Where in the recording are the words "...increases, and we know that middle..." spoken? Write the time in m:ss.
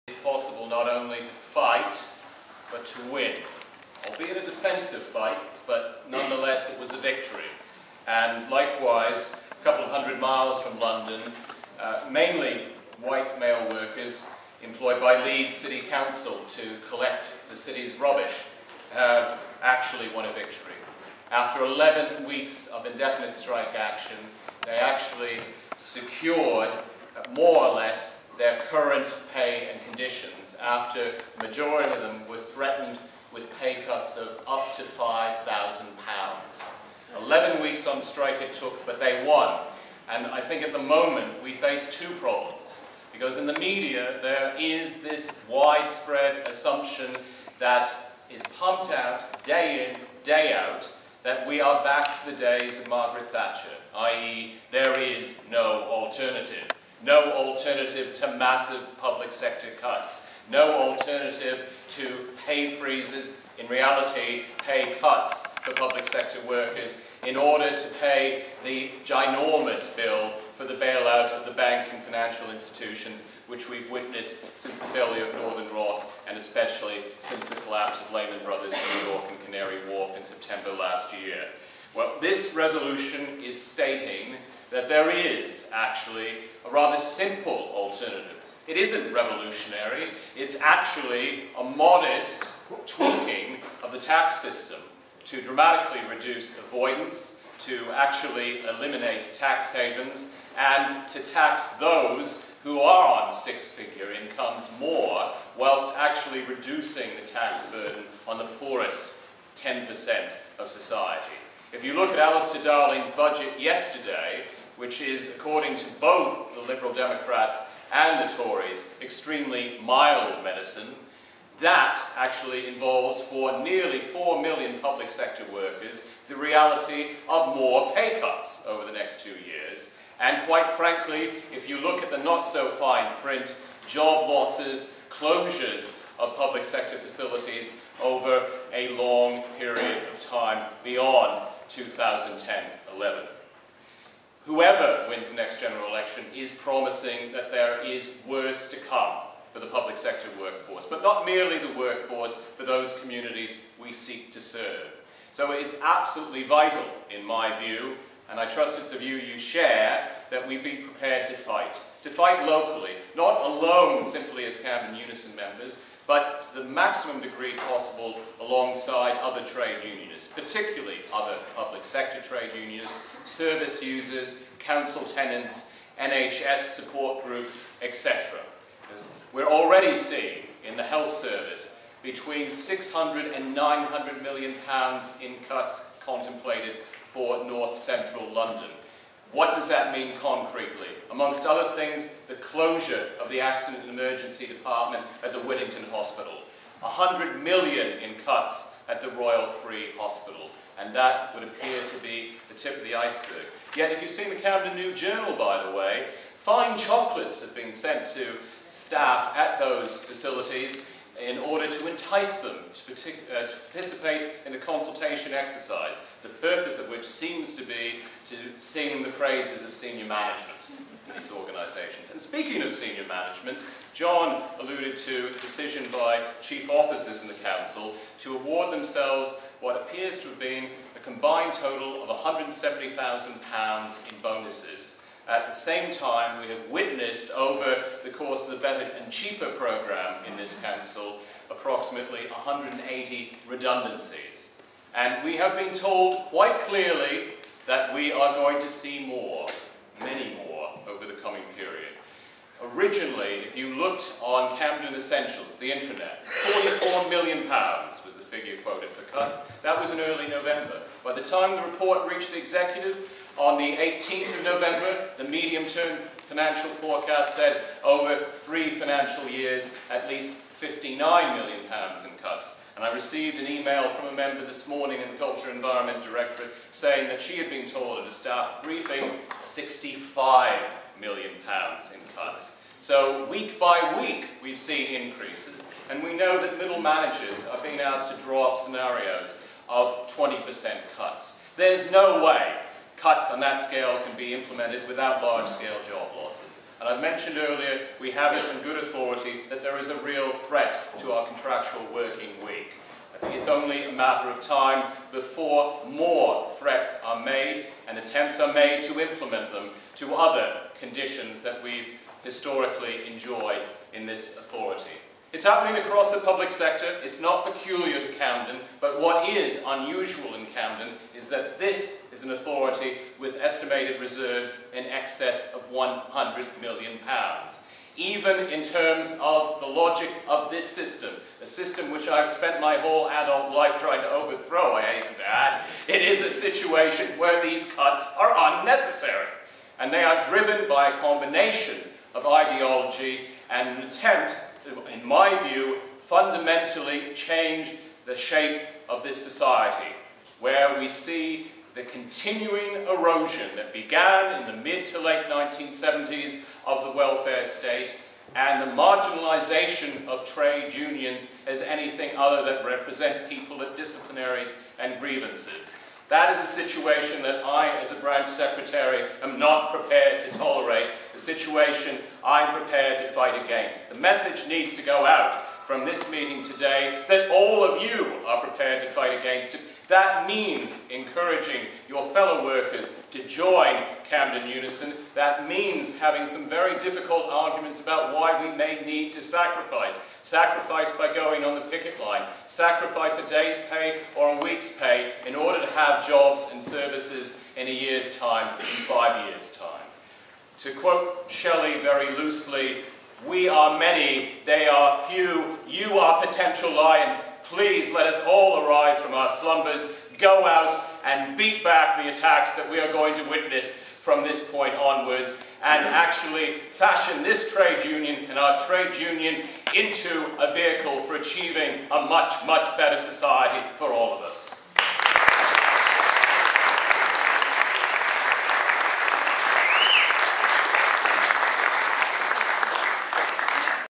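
4:45.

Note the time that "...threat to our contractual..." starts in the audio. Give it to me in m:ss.
5:00.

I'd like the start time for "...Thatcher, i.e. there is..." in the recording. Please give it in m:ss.
0:53.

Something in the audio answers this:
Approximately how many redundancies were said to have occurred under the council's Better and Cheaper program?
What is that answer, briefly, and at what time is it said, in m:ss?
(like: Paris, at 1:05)
180, at 4:02.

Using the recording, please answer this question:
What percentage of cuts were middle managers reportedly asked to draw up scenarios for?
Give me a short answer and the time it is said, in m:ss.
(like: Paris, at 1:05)
20%, at 4:50.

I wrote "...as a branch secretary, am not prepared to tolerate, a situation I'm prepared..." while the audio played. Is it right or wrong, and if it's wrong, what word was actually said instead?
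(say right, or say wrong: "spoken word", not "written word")
right.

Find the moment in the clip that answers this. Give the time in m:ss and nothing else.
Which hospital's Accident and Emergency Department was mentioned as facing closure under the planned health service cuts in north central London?
3:15.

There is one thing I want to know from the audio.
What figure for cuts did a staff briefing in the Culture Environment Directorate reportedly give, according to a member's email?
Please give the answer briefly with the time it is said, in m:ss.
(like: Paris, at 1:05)
£65 million, at 4:39.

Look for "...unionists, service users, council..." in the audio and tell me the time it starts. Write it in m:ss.
2:52.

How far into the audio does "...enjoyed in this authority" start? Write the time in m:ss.
5:13.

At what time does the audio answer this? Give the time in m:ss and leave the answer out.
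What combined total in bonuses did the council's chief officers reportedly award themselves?
3:52.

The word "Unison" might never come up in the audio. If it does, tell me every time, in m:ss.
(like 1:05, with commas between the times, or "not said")
2:44, 6:24.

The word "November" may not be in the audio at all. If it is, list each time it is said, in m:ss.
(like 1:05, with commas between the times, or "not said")
4:20, 4:24.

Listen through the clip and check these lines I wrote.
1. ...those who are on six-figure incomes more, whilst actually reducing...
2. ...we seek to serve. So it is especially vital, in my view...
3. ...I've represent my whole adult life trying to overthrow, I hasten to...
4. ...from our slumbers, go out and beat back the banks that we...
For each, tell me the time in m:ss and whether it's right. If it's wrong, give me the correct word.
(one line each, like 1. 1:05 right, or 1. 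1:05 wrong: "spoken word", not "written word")
1. 1:41 right
2. 2:33 wrong: "absolutely", not "especially"
3. 5:32 wrong: "spent", not "represent"
4. 6:48 wrong: "attacks", not "banks".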